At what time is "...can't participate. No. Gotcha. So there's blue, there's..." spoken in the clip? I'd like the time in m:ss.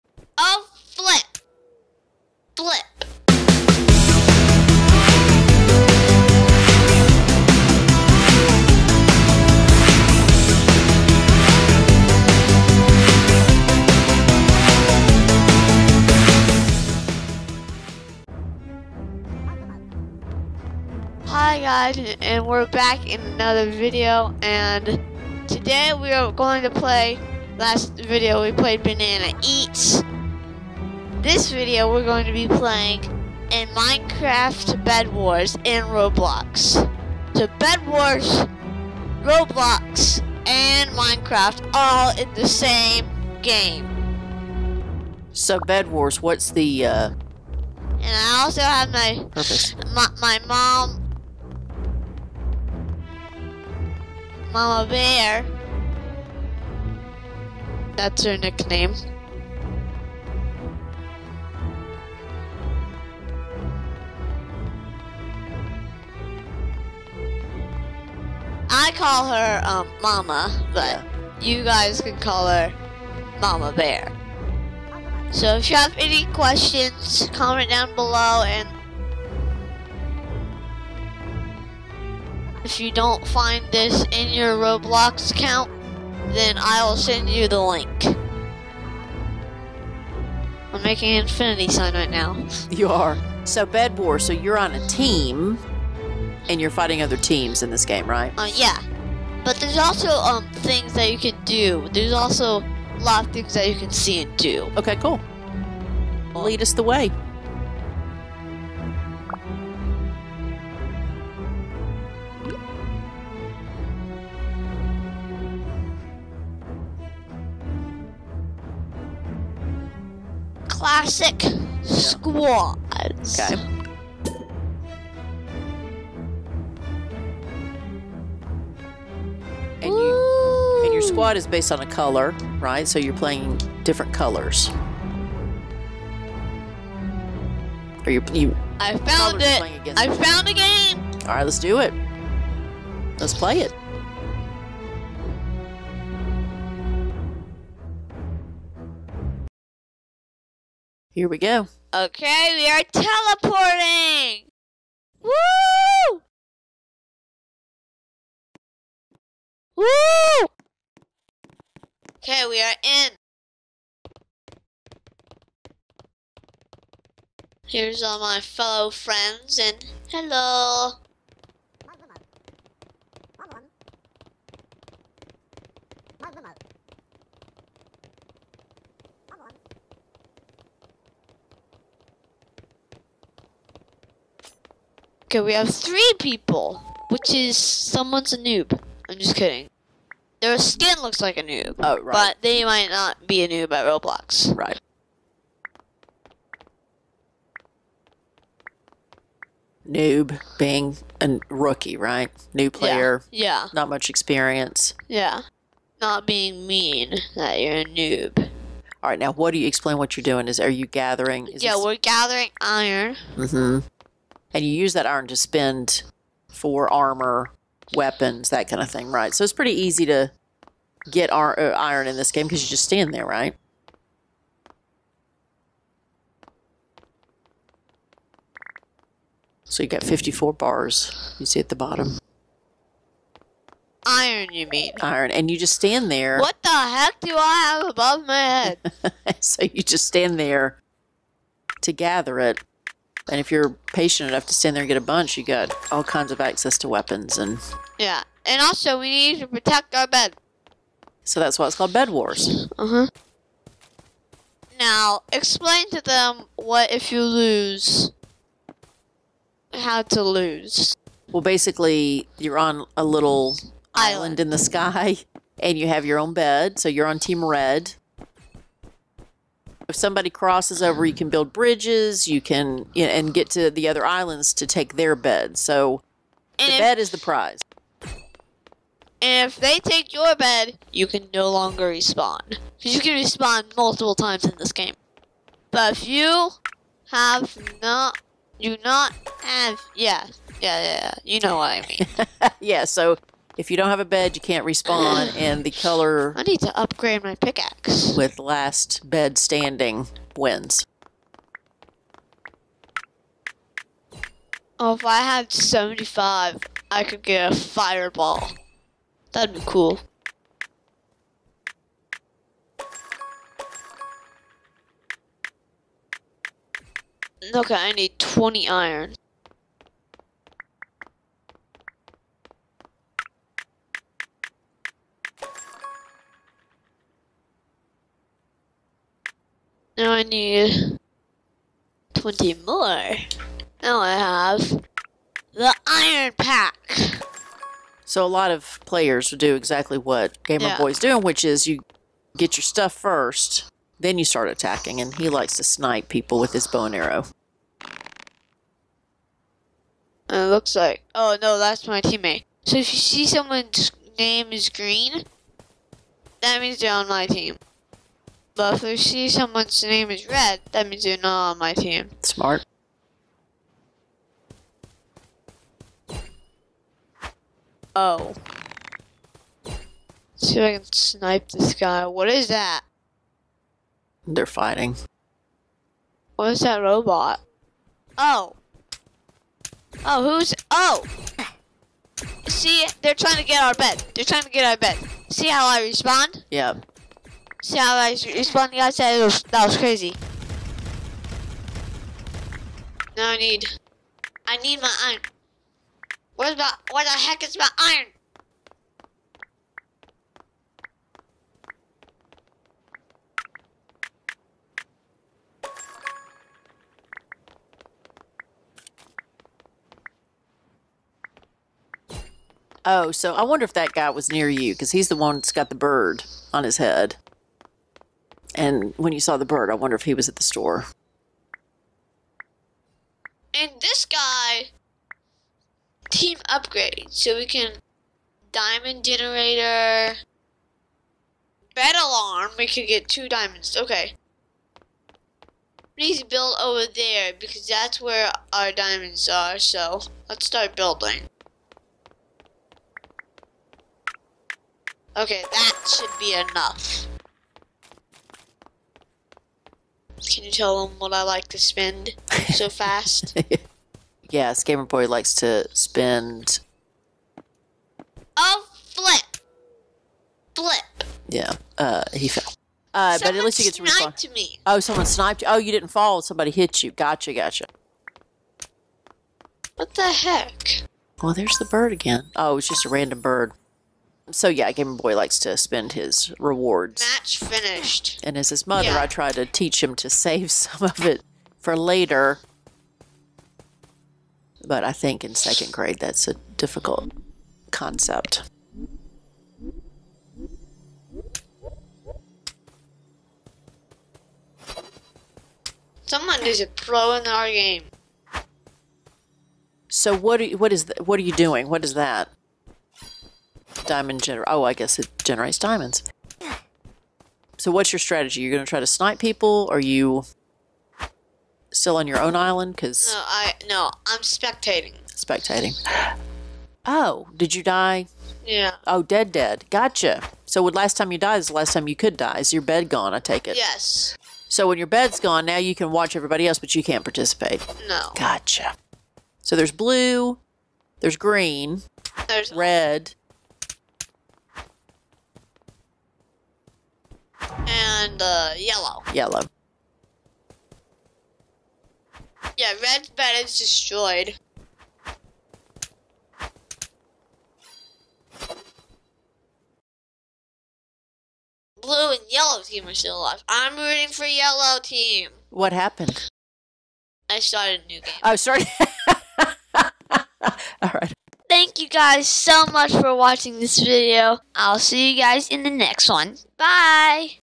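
8:46.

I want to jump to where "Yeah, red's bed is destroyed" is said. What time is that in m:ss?
9:02.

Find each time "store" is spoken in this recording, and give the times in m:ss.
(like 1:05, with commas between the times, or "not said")
7:00.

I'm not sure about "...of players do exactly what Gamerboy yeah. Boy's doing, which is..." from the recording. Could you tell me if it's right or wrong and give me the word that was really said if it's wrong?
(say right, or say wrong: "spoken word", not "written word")
right.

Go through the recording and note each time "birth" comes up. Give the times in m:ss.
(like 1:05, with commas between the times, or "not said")
not said.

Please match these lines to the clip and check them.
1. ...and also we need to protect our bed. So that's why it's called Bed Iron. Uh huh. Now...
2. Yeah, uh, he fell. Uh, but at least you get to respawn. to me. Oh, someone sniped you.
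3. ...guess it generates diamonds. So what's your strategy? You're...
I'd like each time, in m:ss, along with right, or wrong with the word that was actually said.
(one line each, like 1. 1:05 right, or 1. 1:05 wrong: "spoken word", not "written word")
1. 4:08 wrong: "Wars", not "Iron"
2. 7:41 right
3. 8:24 right.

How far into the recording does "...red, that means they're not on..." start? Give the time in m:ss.
6:00.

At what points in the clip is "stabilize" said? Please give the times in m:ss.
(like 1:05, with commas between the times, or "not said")
not said.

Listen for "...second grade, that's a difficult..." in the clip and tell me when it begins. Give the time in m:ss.
8:05.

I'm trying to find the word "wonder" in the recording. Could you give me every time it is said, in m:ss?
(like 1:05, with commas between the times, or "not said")
6:53, 6:59.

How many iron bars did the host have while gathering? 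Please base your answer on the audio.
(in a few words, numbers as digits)
54.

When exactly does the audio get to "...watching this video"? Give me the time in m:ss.
9:23.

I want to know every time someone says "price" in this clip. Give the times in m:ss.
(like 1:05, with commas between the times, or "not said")
not said.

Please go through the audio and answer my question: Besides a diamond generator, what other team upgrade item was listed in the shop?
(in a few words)
bed alarm.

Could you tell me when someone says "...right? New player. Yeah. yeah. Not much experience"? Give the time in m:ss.
3:21.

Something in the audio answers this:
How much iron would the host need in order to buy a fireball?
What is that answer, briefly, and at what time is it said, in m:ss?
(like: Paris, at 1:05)
75, at 5:05.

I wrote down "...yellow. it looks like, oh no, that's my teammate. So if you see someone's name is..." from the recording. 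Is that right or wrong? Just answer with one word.
wrong.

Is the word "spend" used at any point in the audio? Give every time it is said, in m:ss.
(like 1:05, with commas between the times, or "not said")
3:35, 7:31, 7:35, 7:55.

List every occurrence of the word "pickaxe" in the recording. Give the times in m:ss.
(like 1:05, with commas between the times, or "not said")
4:57.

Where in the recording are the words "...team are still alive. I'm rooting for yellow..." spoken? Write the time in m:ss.
9:12.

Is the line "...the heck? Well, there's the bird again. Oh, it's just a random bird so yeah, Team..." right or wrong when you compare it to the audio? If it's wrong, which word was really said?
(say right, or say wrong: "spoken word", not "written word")
wrong: "Gamer", not "Team".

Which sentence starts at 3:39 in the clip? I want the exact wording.
So it's pretty easy to get uh, iron in this game because you just stand there, right?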